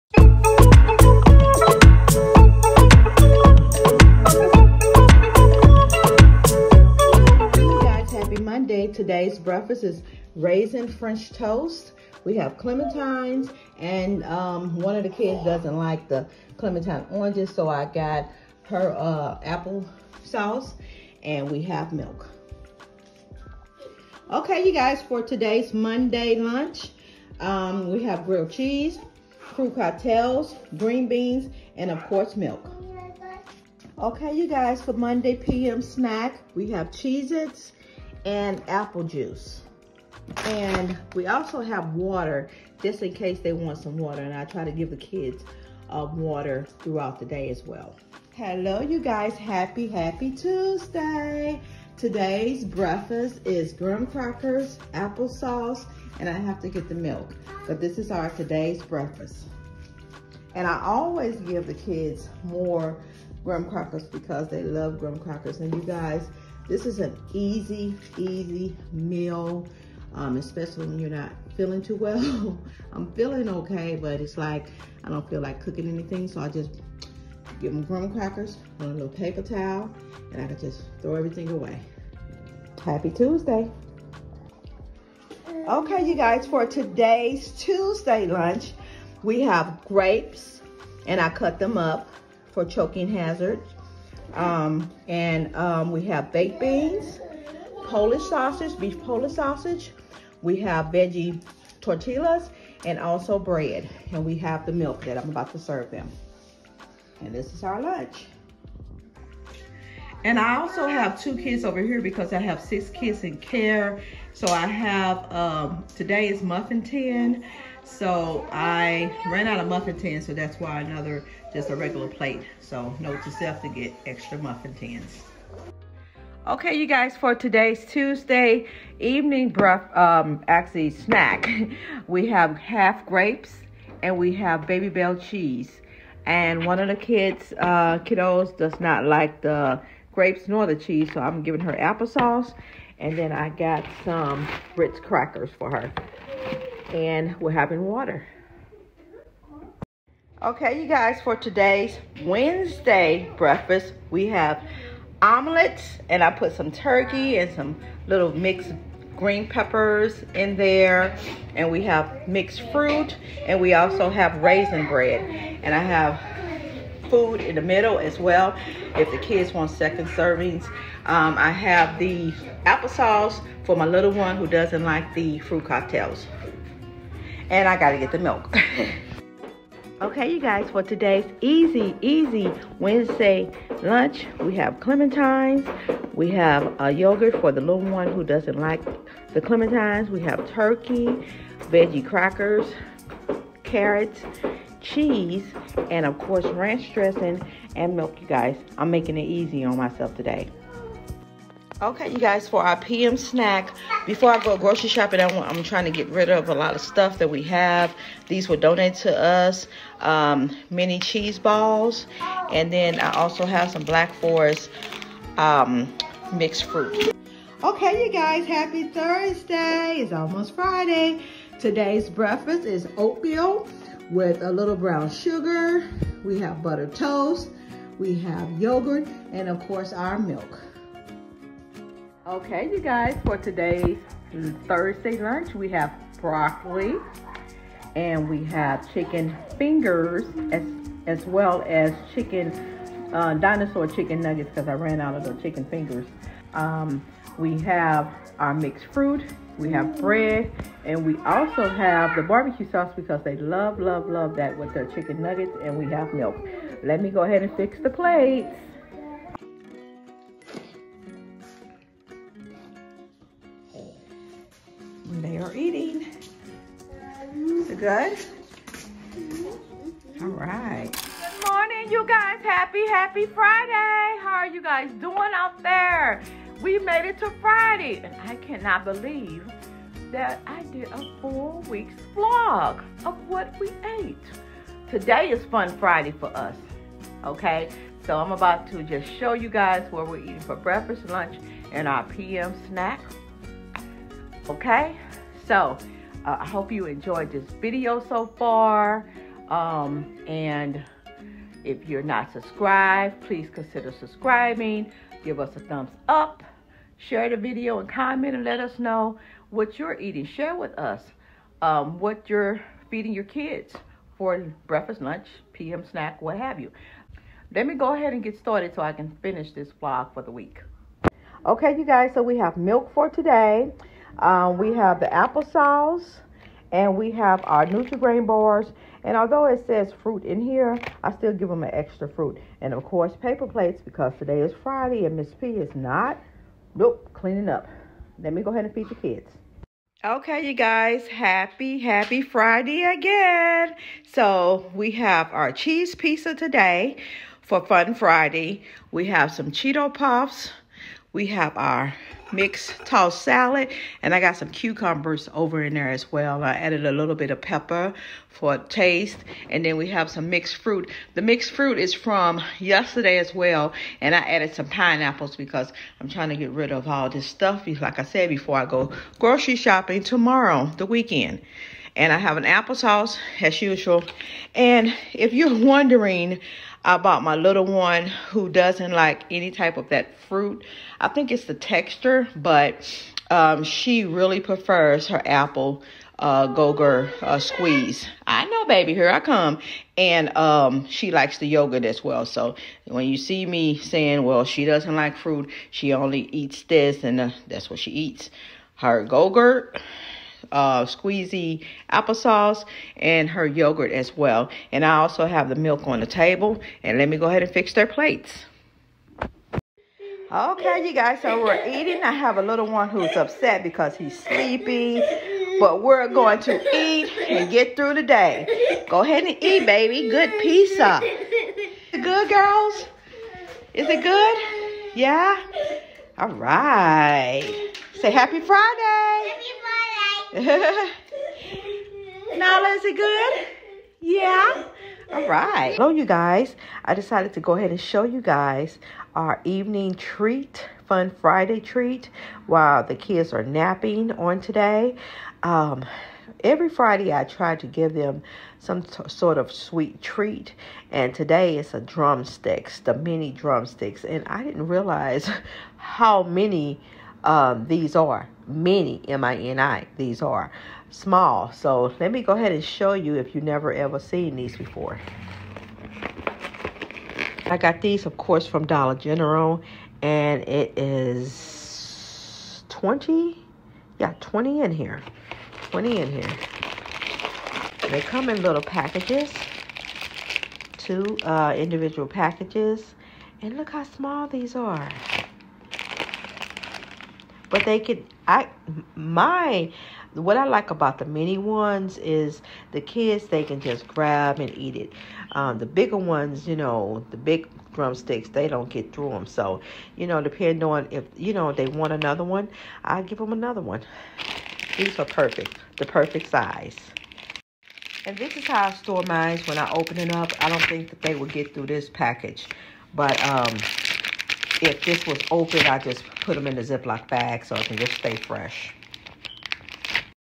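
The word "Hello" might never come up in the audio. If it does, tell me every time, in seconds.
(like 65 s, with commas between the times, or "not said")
48 s, 435 s.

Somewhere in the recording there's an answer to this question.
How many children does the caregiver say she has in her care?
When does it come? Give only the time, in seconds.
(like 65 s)
112 s.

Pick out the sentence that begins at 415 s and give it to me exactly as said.
But we're going to eat and get through the day.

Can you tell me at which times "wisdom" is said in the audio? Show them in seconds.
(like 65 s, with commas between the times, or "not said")
not said.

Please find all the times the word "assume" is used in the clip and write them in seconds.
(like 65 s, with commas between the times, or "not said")
not said.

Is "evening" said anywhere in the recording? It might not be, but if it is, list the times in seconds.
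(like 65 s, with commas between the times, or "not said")
128 s, 439 s.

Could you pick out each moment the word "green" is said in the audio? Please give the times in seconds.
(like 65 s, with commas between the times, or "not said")
30 s, 159 s.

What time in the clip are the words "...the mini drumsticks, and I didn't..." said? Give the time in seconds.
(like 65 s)
452 s.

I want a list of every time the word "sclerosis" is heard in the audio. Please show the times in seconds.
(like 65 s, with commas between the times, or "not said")
not said.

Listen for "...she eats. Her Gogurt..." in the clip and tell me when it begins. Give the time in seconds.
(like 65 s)
397 s.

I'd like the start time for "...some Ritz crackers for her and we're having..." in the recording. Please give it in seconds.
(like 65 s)
144 s.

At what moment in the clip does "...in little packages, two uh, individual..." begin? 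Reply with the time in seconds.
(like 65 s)
478 s.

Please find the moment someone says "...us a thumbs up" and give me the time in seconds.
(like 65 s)
305 s.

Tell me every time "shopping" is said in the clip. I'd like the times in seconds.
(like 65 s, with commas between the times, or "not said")
204 s, 369 s.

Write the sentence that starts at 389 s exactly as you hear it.
And um, she likes the yogurt as well.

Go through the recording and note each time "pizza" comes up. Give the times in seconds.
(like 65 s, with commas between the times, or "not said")
345 s, 420 s.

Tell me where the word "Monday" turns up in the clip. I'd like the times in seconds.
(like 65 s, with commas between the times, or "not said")
25 s, 34 s.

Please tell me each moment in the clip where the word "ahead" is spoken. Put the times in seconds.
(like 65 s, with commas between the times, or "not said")
257 s, 317 s, 338 s, 407 s, 419 s, 437 s, 462 s.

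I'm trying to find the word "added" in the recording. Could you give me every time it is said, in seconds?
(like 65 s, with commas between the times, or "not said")
356 s, 364 s.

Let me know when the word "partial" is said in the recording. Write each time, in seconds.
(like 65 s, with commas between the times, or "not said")
not said.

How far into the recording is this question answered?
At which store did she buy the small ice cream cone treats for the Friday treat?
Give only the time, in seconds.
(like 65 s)
468 s.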